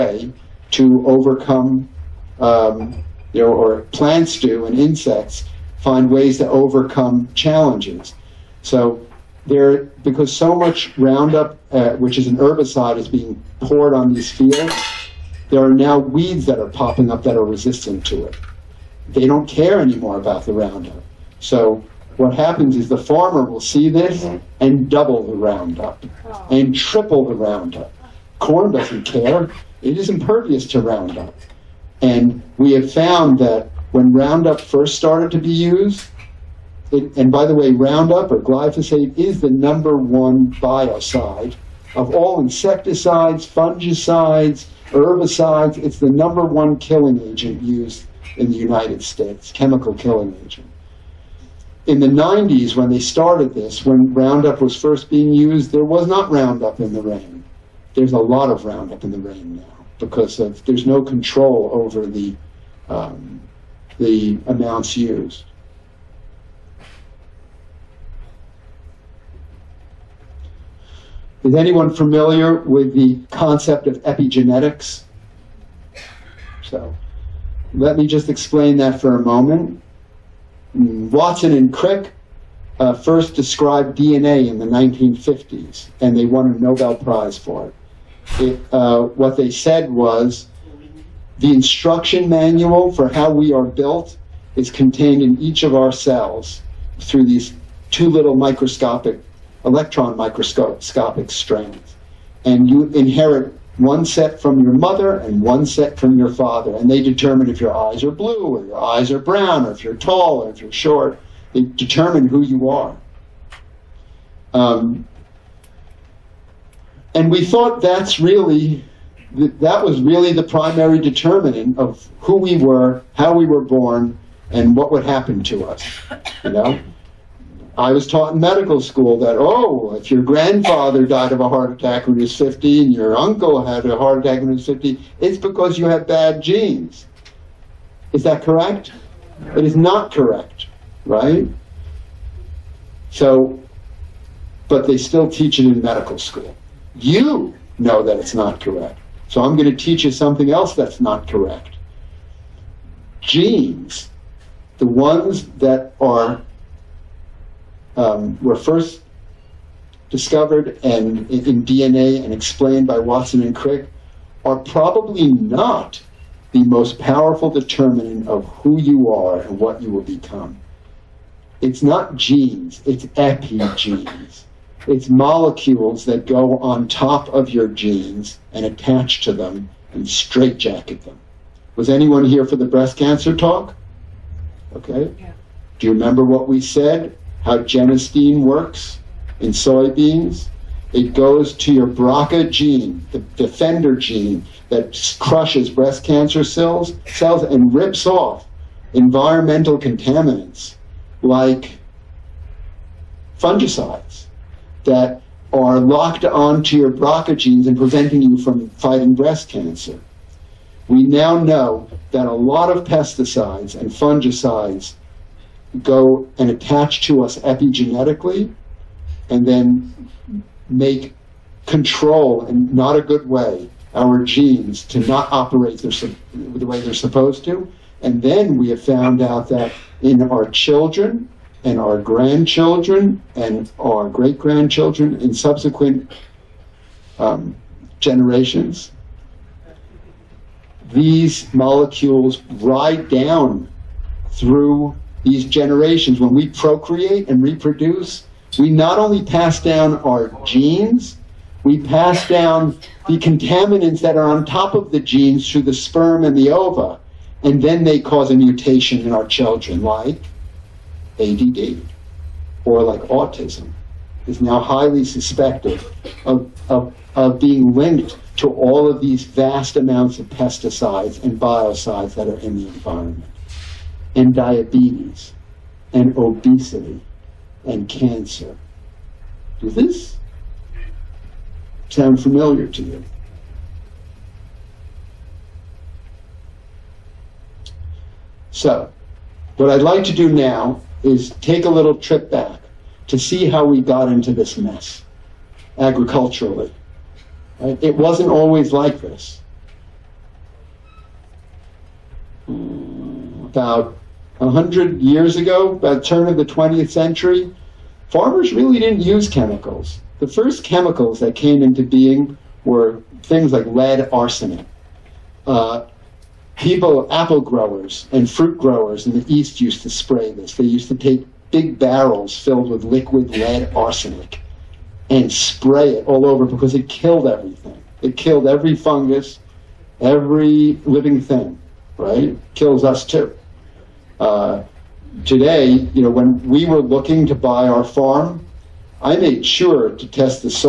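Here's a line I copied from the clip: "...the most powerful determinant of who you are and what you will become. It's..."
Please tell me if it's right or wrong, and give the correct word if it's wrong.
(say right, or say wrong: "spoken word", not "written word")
right.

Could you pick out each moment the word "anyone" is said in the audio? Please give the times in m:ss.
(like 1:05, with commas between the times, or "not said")
1:11, 3:01.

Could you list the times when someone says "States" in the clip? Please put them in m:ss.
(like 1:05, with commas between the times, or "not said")
0:49.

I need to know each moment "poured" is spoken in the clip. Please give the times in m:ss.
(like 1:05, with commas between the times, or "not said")
0:13.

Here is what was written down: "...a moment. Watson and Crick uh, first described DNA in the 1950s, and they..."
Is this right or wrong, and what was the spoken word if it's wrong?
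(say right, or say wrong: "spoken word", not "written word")
right.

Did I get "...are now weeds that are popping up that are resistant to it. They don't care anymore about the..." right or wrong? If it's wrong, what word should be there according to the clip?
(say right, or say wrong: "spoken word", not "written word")
right.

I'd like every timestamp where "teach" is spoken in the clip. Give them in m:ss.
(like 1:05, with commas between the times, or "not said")
2:25, 2:29.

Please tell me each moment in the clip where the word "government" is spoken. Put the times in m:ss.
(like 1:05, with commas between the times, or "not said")
not said.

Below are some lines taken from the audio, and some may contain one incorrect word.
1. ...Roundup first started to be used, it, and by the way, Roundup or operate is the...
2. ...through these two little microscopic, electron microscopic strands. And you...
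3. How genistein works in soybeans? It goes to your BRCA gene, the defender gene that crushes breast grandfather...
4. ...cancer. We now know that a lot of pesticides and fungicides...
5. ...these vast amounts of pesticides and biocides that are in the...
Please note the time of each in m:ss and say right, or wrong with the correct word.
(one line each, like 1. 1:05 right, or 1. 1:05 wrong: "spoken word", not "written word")
1. 0:34 wrong: "glyphosate", not "operate"
2. 1:36 right
3. 3:07 wrong: "cancer", not "grandfather"
4. 3:29 right
5. 4:29 right.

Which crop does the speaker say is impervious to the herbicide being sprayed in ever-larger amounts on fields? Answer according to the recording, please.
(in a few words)
Corn.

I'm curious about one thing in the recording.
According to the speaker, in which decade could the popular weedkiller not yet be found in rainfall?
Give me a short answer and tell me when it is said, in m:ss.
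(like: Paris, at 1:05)
the 90s, at 0:51.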